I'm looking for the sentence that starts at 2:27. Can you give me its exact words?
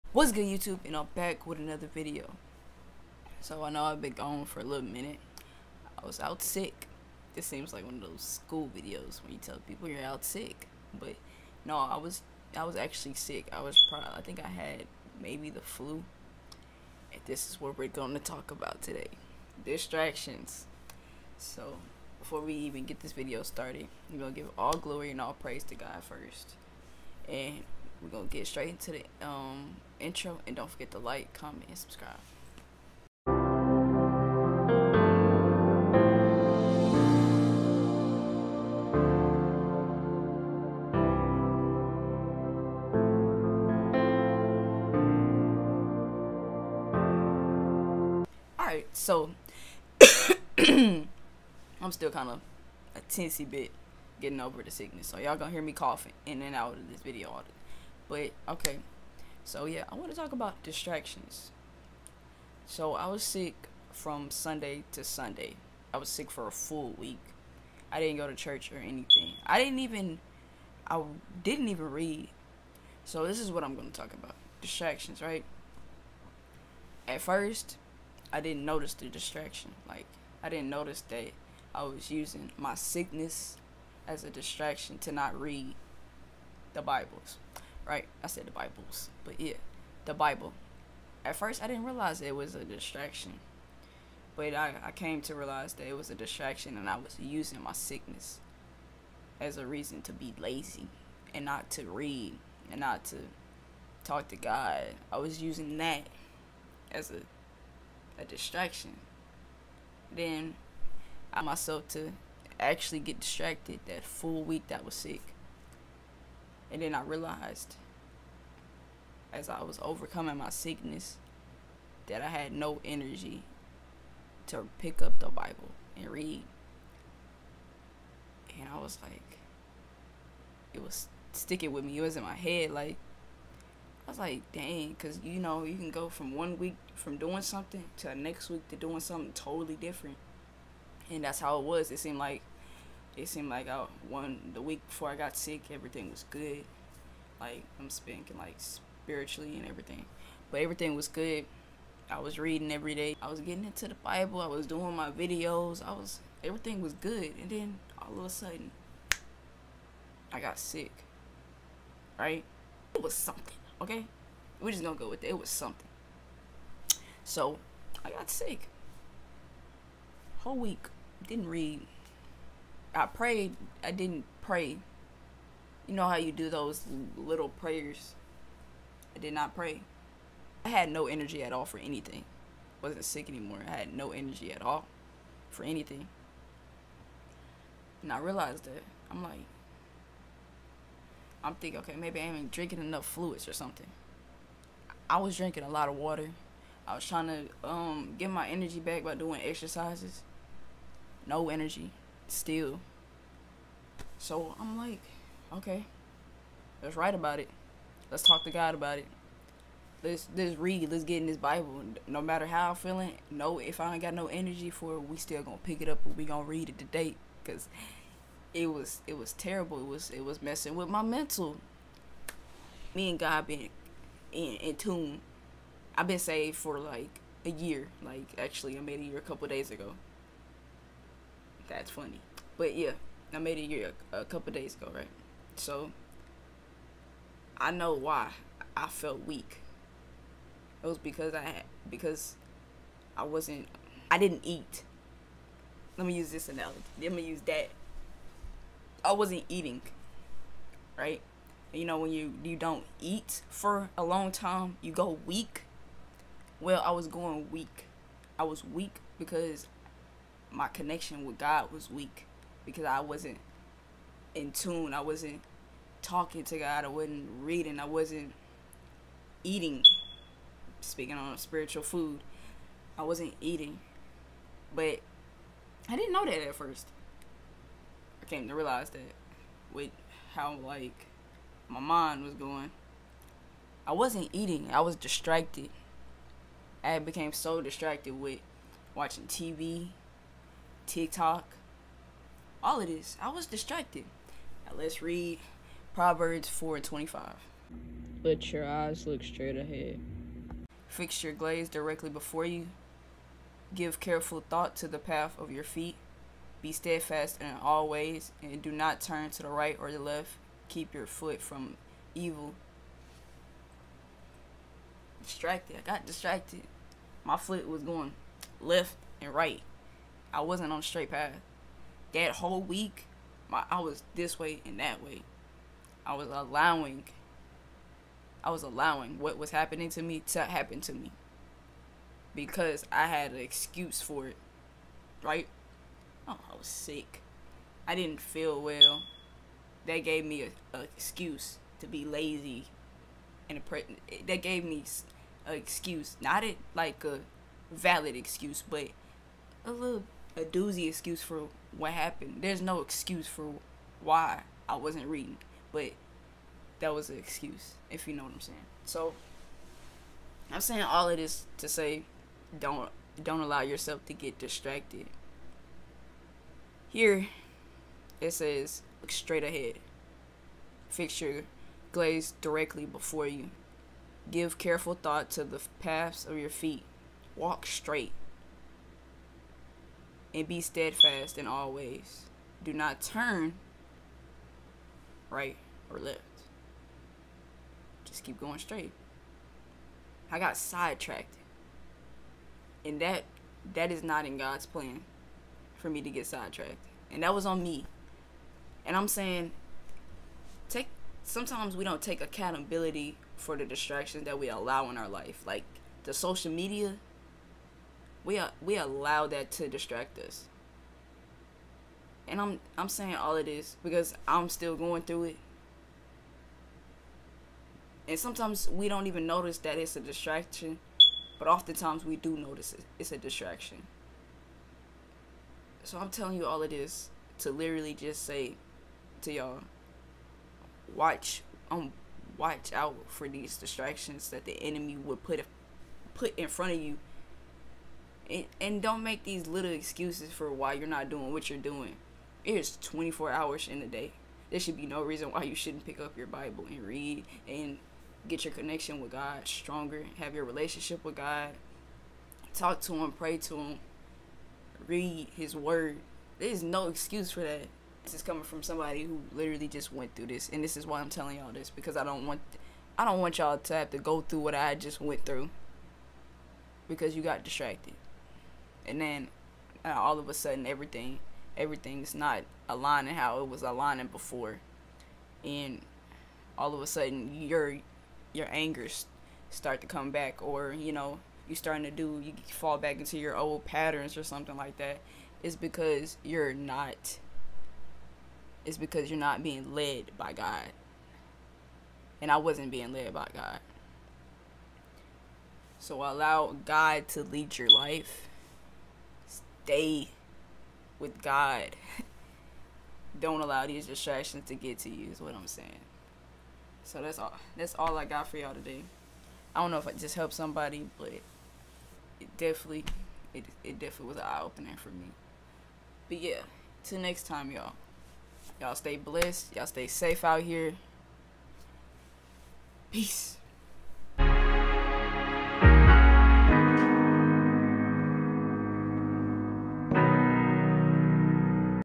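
Like I'm speaking like spiritually and everything, but everything was good.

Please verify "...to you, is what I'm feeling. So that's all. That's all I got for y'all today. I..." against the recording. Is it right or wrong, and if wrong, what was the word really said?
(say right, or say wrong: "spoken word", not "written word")
wrong: "saying", not "feeling".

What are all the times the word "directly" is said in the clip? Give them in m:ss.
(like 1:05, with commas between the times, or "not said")
5:01, 6:12.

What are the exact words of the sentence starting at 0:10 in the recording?
But no, I was I was actually sick.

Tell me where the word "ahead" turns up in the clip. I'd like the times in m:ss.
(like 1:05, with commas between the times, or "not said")
4:59, 6:09.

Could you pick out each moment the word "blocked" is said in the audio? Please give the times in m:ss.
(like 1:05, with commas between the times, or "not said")
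not said.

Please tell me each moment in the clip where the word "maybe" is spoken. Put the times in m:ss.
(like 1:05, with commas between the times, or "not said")
0:15, 3:11.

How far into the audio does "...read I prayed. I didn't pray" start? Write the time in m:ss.
2:51.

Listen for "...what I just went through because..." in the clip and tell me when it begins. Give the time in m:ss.
7:44.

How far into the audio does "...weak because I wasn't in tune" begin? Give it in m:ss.
4:21.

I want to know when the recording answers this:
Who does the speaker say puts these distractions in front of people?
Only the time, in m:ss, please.
7:14.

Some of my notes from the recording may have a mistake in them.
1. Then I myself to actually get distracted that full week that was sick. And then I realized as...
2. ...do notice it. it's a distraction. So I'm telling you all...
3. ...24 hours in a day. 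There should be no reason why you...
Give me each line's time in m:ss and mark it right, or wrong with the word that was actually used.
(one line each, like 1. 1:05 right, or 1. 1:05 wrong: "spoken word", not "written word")
1. 1:50 right
2. 7:02 right
3. 7:22 right.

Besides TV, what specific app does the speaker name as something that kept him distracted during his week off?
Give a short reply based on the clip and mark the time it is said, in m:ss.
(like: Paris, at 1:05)
TikTok, at 4:50.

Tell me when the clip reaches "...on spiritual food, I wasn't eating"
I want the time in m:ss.
4:31.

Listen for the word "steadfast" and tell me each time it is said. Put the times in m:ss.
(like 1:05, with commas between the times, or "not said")
5:06, 6:20.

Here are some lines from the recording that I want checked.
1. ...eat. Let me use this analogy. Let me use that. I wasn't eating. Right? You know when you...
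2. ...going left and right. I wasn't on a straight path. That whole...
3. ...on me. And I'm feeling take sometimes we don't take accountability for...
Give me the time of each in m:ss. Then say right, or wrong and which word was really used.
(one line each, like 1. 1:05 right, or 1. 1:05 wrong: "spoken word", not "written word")
1. 4:04 right
2. 5:17 right
3. 6:37 wrong: "saying", not "feeling".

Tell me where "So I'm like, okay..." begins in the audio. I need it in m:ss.
3:24.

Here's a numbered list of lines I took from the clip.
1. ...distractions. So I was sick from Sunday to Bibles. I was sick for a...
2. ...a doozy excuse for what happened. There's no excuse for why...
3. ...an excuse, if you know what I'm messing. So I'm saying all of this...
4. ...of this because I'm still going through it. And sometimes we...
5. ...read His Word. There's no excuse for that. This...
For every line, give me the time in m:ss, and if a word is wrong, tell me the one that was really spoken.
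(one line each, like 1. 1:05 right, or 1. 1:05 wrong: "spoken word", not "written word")
1. 1:00 wrong: "Sunday", not "Bibles"
2. 5:50 right
3. 5:57 wrong: "saying", not "messing"
4. 6:53 right
5. 7:34 right.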